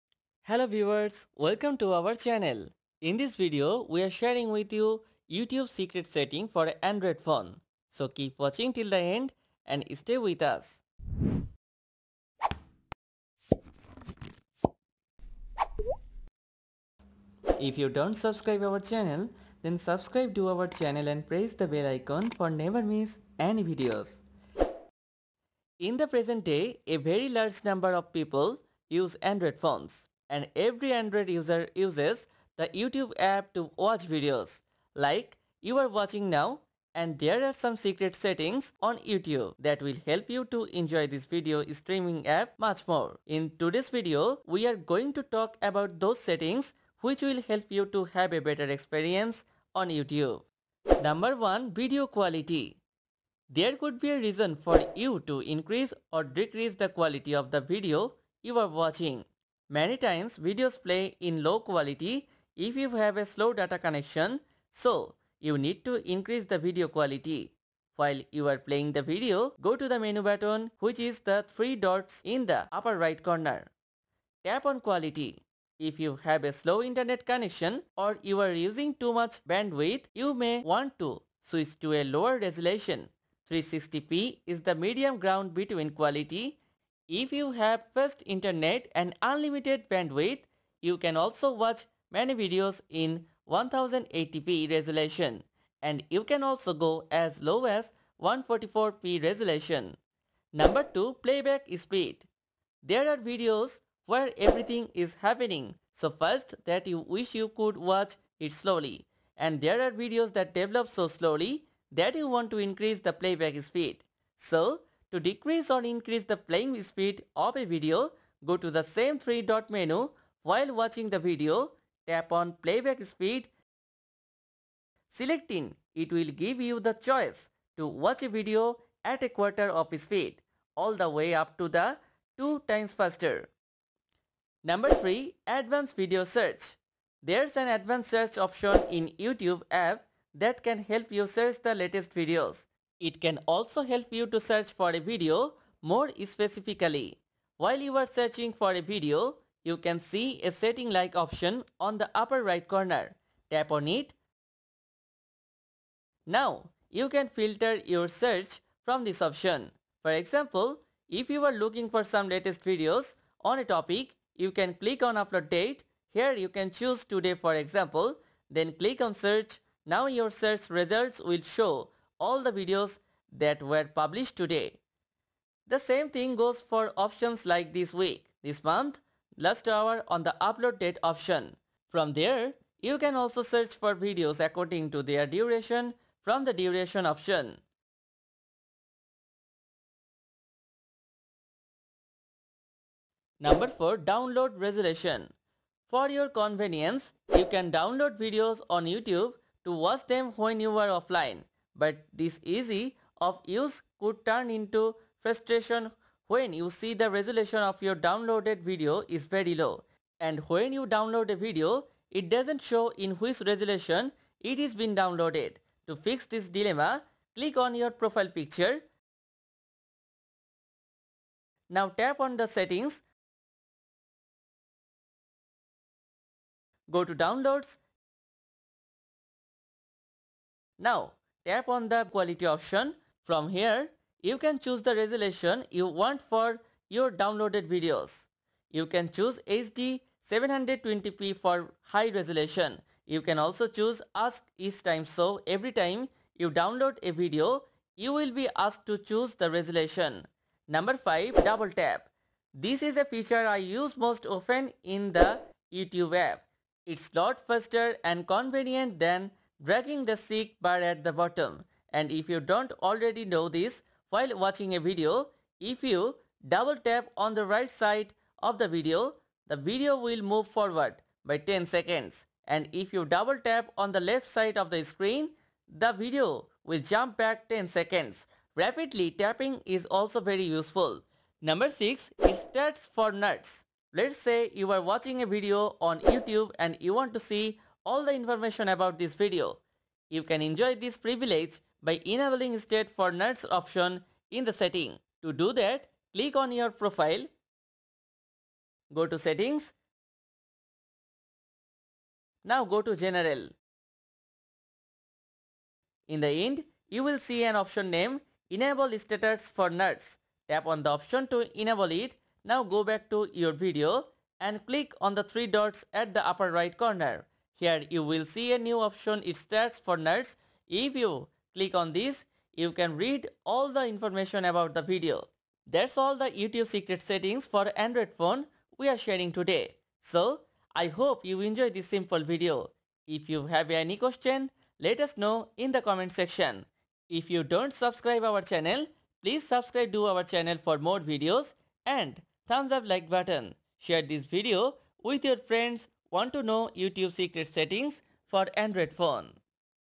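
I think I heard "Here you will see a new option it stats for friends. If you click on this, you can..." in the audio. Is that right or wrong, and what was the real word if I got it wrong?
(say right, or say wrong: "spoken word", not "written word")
wrong: "nerds", not "friends".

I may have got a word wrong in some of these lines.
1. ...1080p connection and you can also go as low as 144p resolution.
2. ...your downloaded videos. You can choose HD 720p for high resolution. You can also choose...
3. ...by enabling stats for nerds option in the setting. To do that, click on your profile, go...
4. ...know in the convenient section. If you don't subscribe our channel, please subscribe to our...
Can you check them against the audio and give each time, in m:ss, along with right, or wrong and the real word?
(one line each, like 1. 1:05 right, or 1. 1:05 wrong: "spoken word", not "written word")
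1. 1:33 wrong: "resolution", not "connection"
2. 3:56 right
3. 4:51 right
4. 5:35 wrong: "comment", not "convenient".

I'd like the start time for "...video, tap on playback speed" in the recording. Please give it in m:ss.
2:01.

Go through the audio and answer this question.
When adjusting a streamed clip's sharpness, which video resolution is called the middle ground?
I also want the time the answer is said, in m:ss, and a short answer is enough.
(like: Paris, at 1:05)
360p, at 1:23.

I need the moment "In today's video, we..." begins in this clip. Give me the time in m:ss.
0:43.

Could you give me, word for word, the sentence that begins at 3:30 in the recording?
And when you download a video, it doesn't show in which resolution it is been downloaded.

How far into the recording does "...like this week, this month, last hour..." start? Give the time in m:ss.
2:57.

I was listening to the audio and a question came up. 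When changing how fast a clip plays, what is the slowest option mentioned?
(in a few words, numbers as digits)
a quarter of speed.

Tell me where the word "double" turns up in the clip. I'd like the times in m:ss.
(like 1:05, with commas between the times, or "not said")
4:11, 4:26, 4:33.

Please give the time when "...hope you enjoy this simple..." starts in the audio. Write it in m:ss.
5:30.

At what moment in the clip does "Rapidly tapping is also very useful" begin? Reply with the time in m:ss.
4:38.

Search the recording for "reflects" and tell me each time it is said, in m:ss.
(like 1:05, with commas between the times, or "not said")
not said.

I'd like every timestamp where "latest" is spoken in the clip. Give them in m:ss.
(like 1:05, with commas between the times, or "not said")
2:21, 2:42.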